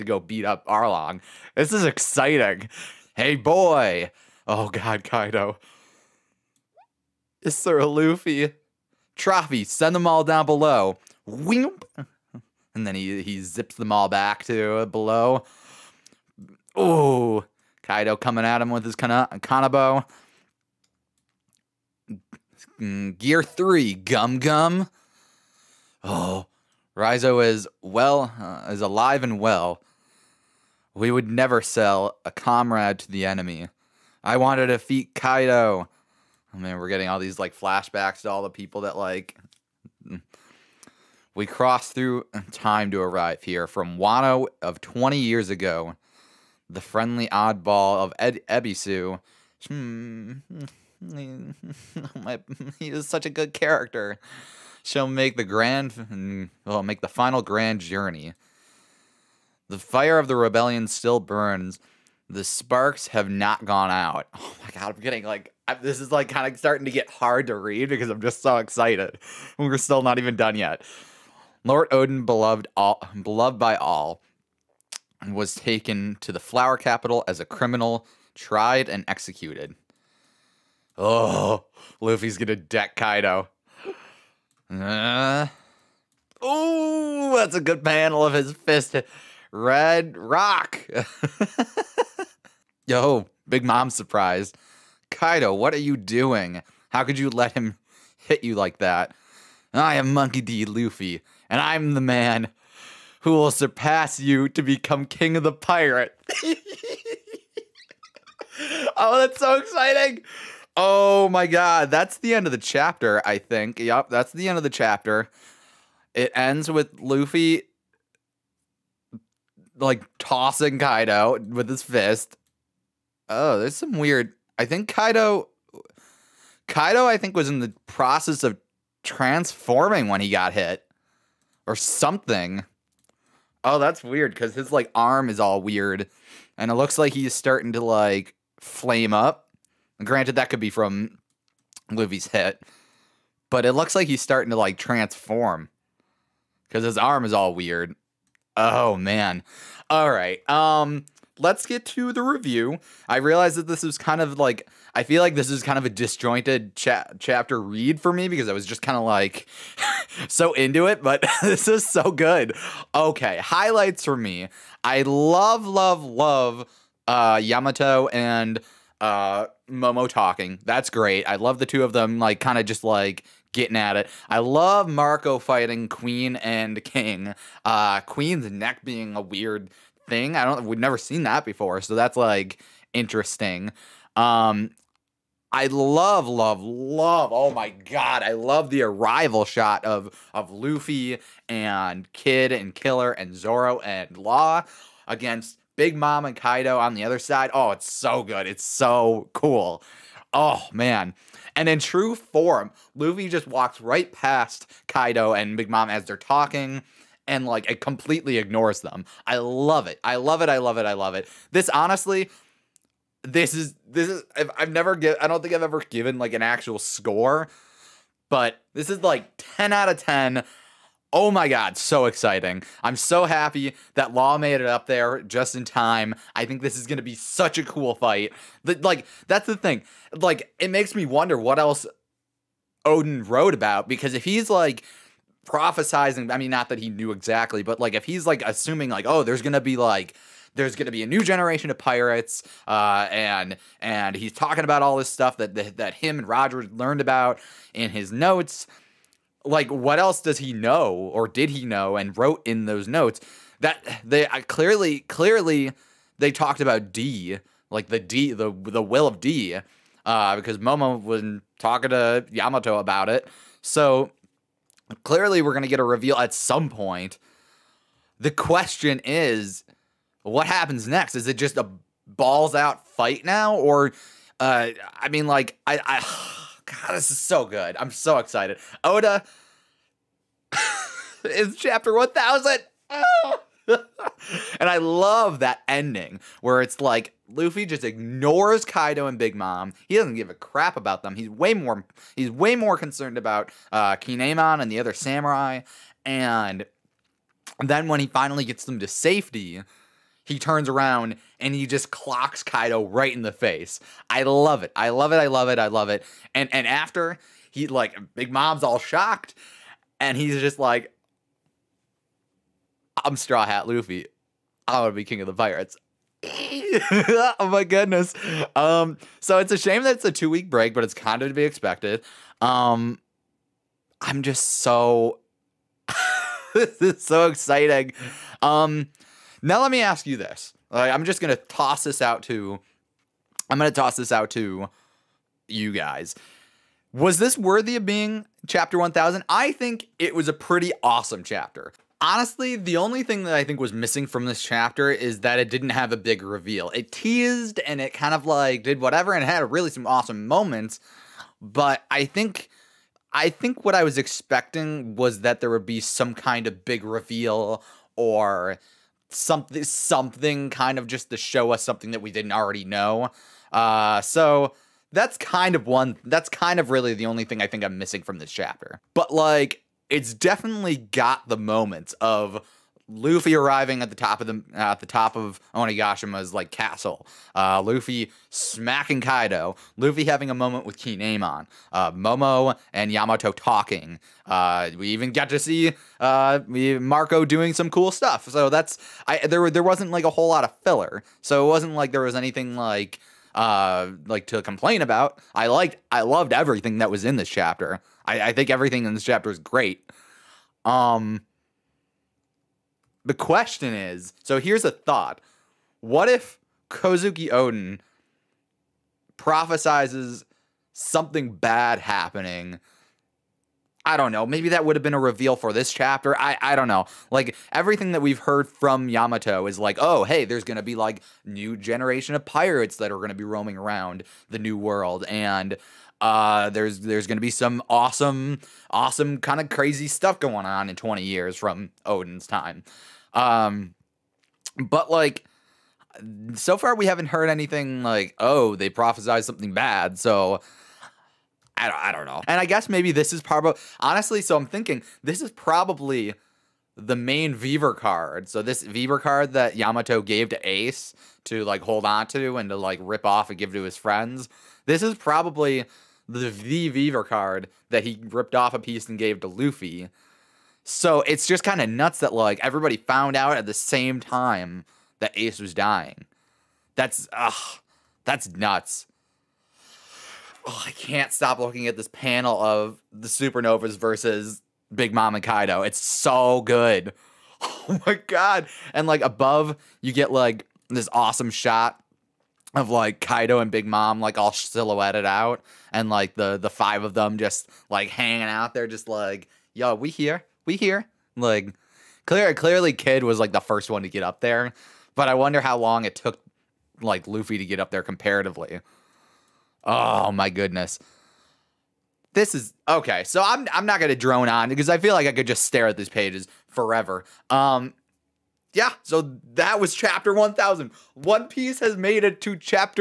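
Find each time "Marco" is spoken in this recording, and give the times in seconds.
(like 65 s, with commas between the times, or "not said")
174 s, 386 s.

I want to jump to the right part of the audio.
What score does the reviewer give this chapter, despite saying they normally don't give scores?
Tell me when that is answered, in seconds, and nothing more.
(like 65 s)
219 s.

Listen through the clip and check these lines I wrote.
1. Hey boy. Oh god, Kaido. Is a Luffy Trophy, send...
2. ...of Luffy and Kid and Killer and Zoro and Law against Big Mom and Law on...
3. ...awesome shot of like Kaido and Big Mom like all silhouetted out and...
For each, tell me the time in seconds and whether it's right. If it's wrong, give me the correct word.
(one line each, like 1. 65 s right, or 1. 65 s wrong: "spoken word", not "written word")
1. 3 s right
2. 190 s wrong: "Kaido", not "Law"
3. 480 s right.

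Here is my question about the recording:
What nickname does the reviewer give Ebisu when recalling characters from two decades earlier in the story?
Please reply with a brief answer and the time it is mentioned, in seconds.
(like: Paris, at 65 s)
friendly oddball, at 46 s.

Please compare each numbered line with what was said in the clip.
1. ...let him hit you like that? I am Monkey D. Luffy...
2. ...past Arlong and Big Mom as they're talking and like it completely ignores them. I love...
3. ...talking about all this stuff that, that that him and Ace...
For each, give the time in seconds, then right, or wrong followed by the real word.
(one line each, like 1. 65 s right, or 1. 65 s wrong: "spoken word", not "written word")
1. 97 s right
2. 204 s wrong: "Kaido", not "Arlong"
3. 244 s wrong: "Roger", not "Ace".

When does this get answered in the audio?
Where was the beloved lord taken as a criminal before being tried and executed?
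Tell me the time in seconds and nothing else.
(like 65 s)
76 s.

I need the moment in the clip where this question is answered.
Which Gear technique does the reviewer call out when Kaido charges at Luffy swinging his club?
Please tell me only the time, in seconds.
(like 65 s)
23 s.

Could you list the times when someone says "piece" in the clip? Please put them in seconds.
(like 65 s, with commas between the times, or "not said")
458 s, 511 s.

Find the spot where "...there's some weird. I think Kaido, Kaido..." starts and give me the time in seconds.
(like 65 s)
123 s.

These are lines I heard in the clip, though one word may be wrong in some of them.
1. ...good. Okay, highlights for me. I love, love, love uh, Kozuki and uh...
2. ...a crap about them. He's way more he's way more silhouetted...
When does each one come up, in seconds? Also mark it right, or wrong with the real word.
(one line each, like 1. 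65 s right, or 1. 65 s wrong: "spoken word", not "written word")
1. 162 s wrong: "Yamato", not "Kozuki"
2. 290 s wrong: "concerned", not "silhouetted".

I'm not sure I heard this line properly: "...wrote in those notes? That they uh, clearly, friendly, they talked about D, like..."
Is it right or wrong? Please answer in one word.
wrong.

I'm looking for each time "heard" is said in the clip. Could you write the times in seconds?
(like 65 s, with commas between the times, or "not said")
418 s, 437 s.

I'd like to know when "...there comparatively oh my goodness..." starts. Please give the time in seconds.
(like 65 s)
497 s.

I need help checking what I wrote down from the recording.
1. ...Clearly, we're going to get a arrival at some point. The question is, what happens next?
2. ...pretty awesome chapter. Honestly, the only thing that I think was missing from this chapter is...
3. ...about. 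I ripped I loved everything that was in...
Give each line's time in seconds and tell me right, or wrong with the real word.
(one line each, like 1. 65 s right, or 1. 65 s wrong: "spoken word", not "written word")
1. 265 s wrong: "reveal", not "arrival"
2. 340 s right
3. 394 s wrong: "liked", not "ripped".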